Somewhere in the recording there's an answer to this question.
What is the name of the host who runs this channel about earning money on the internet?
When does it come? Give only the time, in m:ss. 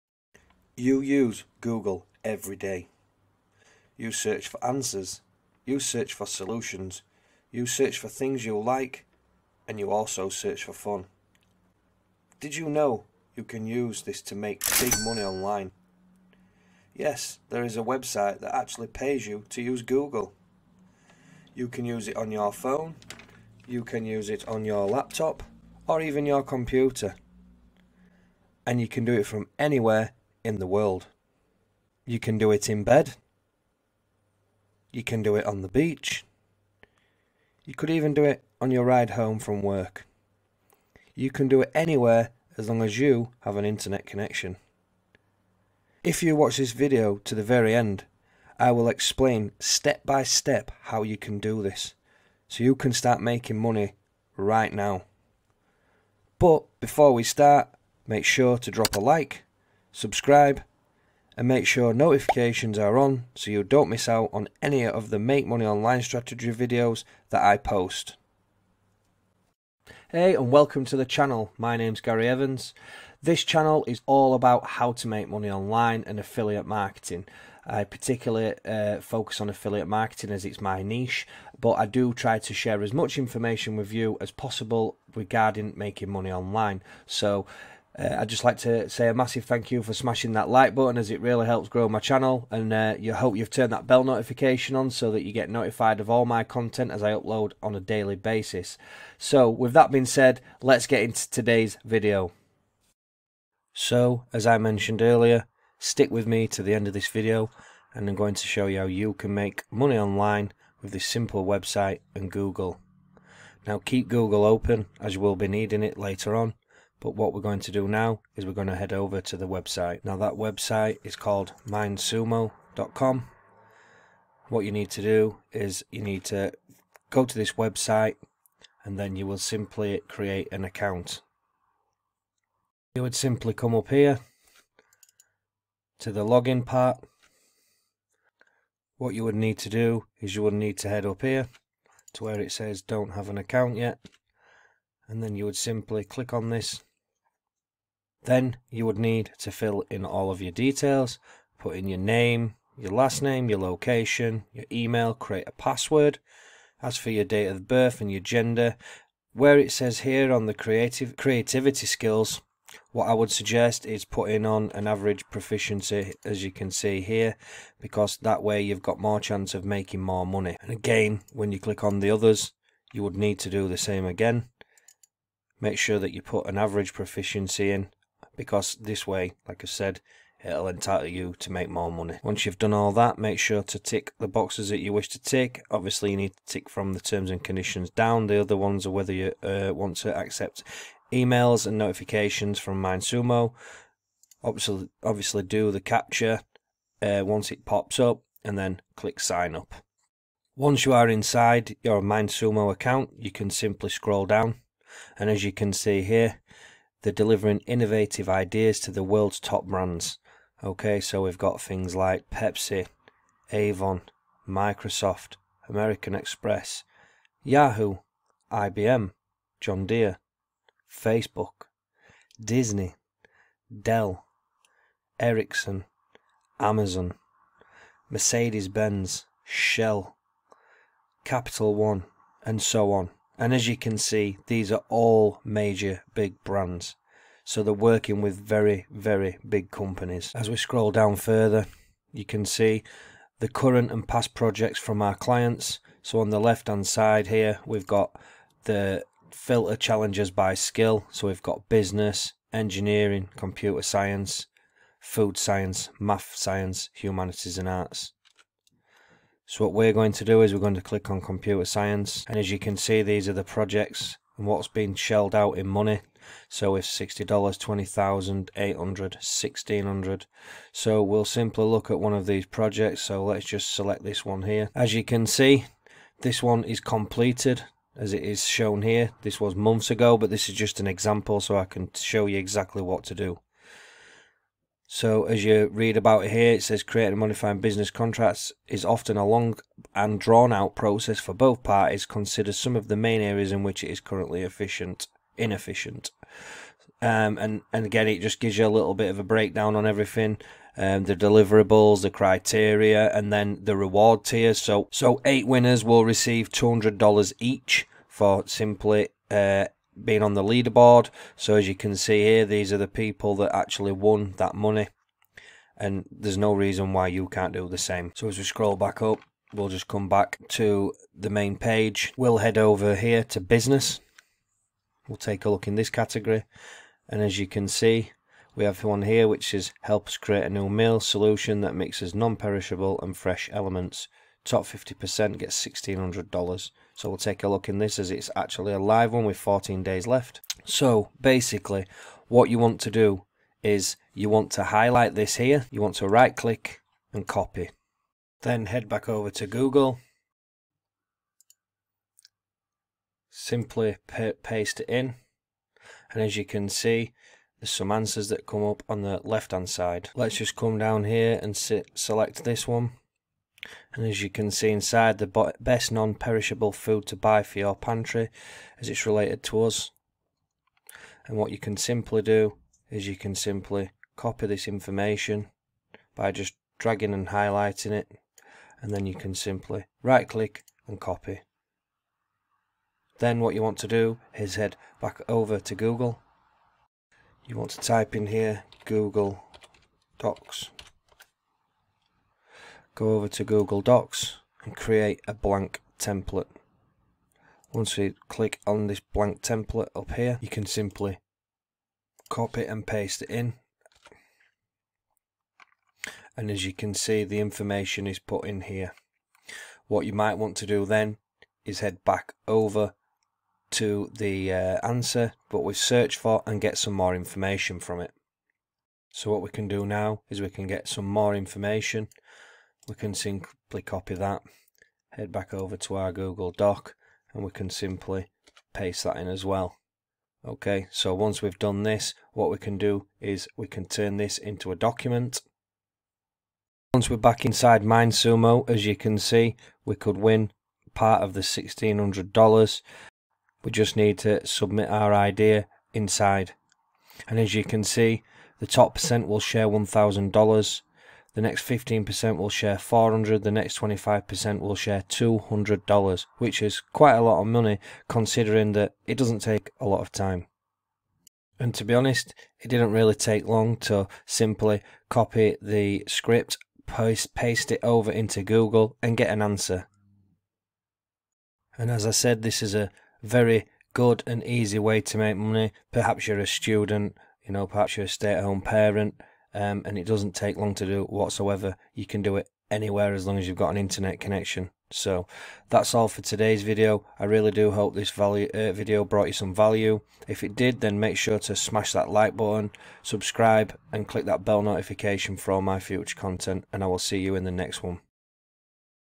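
1:12.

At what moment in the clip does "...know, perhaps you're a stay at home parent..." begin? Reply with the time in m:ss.
7:57.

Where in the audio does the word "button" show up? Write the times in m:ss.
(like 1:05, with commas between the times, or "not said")
1:30, 8:12.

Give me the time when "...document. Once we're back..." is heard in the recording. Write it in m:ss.
7:14.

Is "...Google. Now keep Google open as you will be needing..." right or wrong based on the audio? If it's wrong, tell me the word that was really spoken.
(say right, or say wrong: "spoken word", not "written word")
right.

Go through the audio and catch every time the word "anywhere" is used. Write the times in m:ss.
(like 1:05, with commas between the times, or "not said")
0:29, 0:41, 8:02.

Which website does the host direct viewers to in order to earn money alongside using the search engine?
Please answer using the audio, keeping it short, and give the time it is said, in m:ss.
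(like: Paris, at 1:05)
mindsumo.com, at 2:01.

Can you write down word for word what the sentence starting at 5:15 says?
And there's no reason why you can't do the same.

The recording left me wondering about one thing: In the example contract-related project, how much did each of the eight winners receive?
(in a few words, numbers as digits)
$200.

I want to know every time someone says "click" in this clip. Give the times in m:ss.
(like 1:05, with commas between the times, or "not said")
2:26, 2:51, 3:18, 4:20, 5:46, 6:20, 6:38, 8:14.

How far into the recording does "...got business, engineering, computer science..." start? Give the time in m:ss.
4:11.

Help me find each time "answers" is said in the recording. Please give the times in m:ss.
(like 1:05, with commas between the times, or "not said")
0:04, 5:57, 6:54, 7:49.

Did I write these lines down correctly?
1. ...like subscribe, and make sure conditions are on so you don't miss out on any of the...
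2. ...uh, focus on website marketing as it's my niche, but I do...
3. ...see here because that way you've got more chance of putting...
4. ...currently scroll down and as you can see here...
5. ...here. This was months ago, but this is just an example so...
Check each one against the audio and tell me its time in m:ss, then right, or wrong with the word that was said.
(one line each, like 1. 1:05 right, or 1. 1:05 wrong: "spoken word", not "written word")
1. 0:58 wrong: "notifications", not "conditions"
2. 1:18 wrong: "affiliate", not "website"
3. 2:46 wrong: "making", not "putting"
4. 3:23 wrong: "simply", not "currently"
5. 4:38 right.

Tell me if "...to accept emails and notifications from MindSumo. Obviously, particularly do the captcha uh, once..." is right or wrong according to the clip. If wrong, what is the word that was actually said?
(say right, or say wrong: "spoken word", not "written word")
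wrong: "obviously", not "particularly".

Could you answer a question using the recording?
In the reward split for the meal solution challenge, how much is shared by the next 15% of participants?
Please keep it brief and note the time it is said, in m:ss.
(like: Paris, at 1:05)
$400, at 7:32.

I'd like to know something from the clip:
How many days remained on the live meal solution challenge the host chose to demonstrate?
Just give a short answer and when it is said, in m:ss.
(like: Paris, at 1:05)
14, at 5:39.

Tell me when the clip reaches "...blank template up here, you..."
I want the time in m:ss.
6:38.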